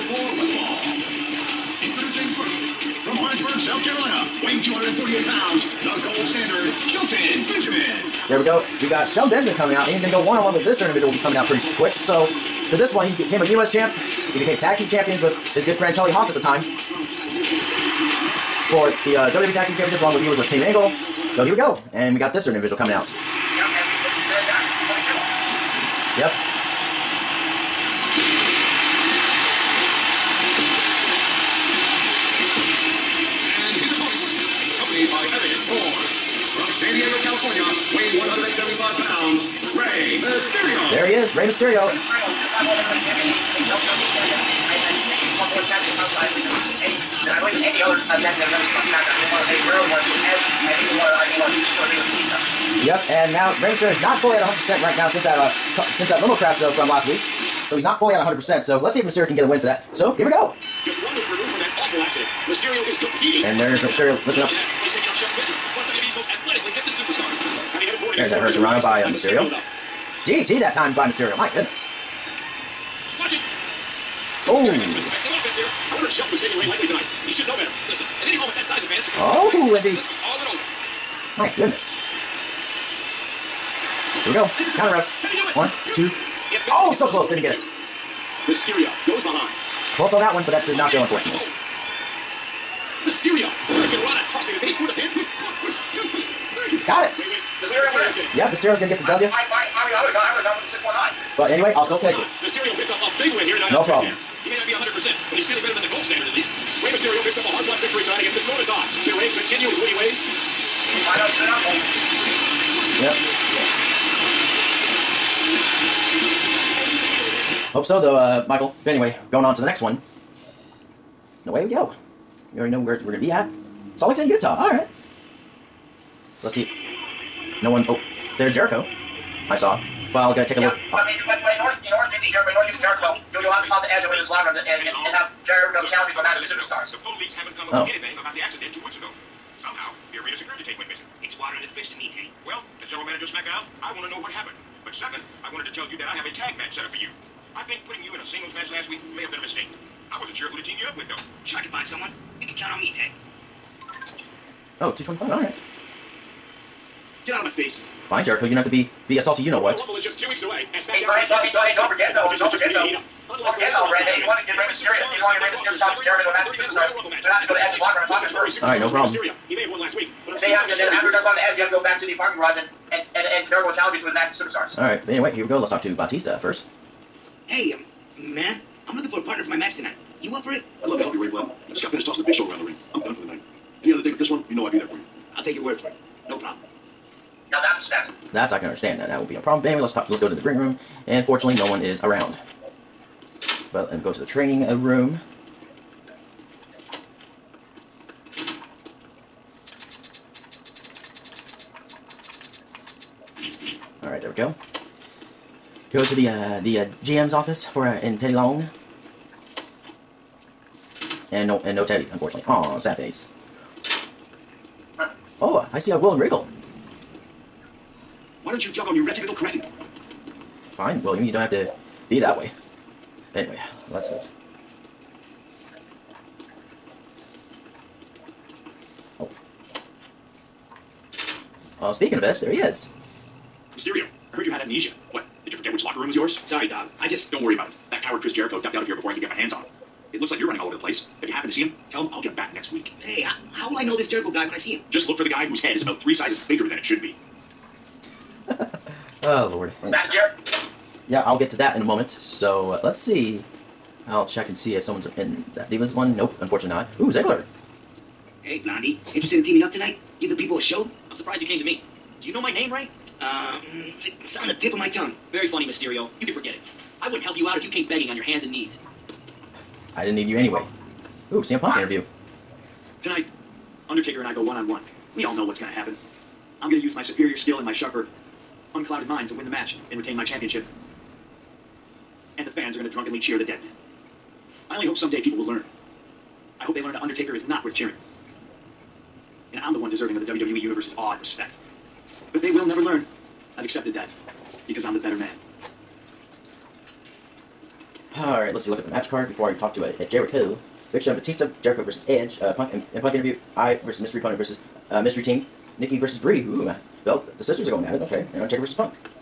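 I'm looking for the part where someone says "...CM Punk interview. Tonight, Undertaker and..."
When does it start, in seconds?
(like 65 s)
271 s.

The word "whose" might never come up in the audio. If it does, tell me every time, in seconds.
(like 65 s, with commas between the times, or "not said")
245 s.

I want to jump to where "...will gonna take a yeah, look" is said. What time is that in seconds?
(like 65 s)
130 s.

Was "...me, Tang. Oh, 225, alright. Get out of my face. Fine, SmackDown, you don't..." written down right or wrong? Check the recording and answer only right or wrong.
wrong.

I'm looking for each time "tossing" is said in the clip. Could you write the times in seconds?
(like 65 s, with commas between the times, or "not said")
94 s, 182 s.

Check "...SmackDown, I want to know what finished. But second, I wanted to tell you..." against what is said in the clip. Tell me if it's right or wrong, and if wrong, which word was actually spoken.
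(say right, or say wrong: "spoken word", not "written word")
wrong: "happened", not "finished".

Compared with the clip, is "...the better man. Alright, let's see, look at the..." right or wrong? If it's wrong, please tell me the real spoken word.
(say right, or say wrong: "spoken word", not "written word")
right.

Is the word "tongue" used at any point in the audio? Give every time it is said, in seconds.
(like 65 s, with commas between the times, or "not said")
264 s.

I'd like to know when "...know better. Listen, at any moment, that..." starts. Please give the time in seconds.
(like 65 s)
77 s.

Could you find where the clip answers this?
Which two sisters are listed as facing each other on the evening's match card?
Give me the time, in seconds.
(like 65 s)
305 s.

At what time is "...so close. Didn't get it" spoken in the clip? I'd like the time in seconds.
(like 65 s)
86 s.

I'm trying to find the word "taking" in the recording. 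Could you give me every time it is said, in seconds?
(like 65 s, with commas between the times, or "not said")
64 s, 76 s.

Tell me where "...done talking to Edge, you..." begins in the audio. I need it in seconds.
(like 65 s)
171 s.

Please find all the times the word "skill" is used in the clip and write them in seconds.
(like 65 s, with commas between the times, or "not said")
277 s.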